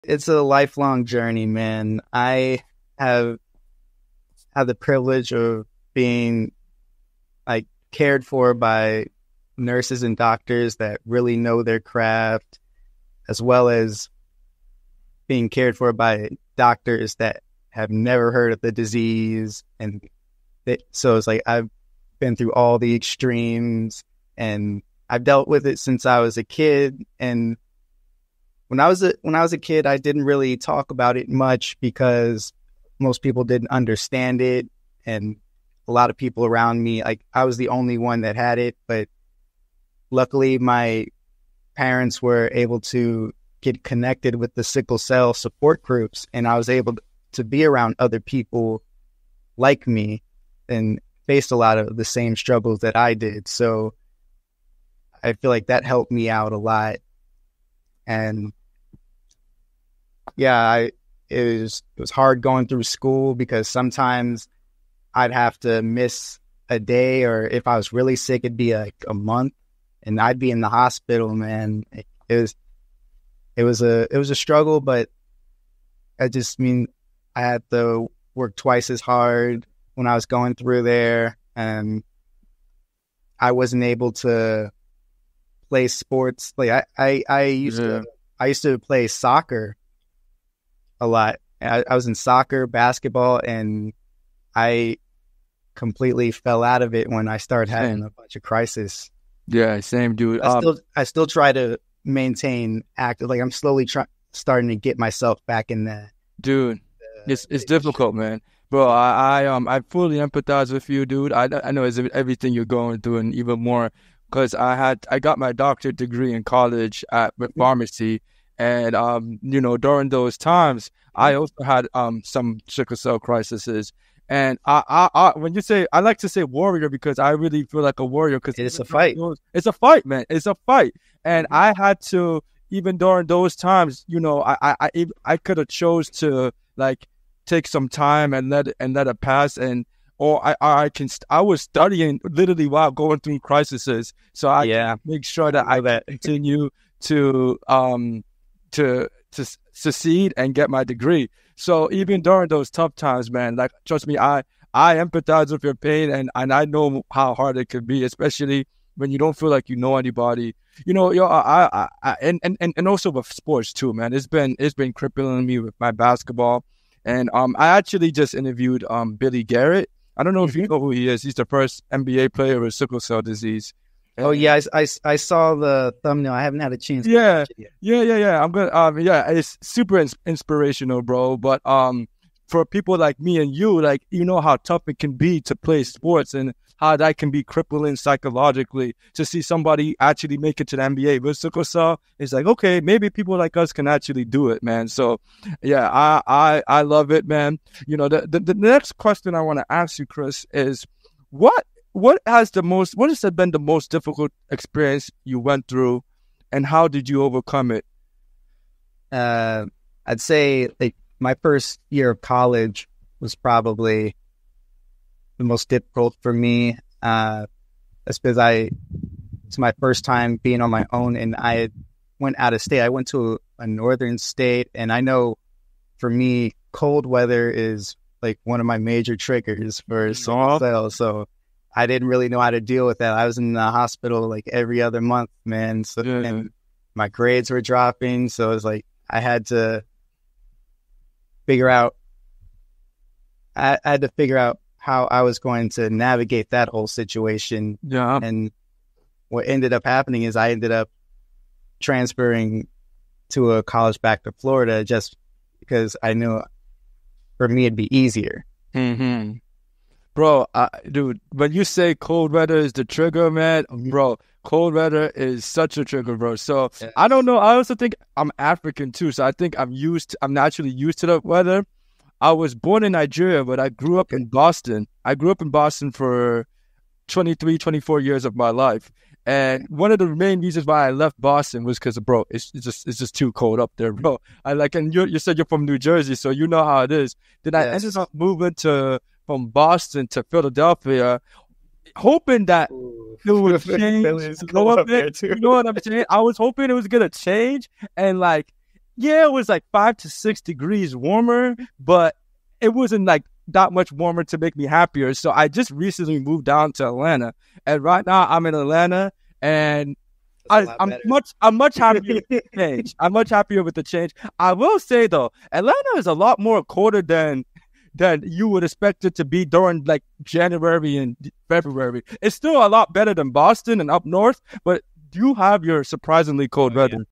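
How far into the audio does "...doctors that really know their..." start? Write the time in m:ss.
0:10.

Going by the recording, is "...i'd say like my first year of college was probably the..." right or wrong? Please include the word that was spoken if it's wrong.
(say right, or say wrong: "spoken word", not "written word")
right.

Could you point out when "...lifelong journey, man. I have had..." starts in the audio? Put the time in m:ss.
0:00.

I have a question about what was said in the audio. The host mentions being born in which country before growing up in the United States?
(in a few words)
Nigeria.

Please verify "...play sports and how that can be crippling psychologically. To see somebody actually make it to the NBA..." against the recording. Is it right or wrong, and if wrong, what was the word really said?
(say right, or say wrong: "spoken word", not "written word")
right.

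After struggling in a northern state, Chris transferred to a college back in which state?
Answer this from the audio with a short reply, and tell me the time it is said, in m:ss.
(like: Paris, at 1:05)
Florida, at 4:14.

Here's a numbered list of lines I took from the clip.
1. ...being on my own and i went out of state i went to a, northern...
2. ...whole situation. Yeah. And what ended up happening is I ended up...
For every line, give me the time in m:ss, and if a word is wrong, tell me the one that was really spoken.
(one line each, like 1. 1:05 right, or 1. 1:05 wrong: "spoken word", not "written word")
1. 3:40 right
2. 4:06 right.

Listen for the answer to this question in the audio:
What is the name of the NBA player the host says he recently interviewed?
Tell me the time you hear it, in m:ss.
2:49.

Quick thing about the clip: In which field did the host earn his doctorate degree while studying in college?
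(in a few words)
Pharmacy.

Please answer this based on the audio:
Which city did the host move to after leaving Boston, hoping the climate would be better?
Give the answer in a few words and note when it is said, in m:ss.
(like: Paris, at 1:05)
Philadelphia, at 4:50.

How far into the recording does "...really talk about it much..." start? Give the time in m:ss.
0:30.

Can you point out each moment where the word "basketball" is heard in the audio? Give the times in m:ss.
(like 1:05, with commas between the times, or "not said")
1:32, 2:45.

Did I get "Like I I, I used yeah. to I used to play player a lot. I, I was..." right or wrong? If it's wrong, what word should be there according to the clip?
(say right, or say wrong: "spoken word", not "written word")
wrong: "soccer", not "player".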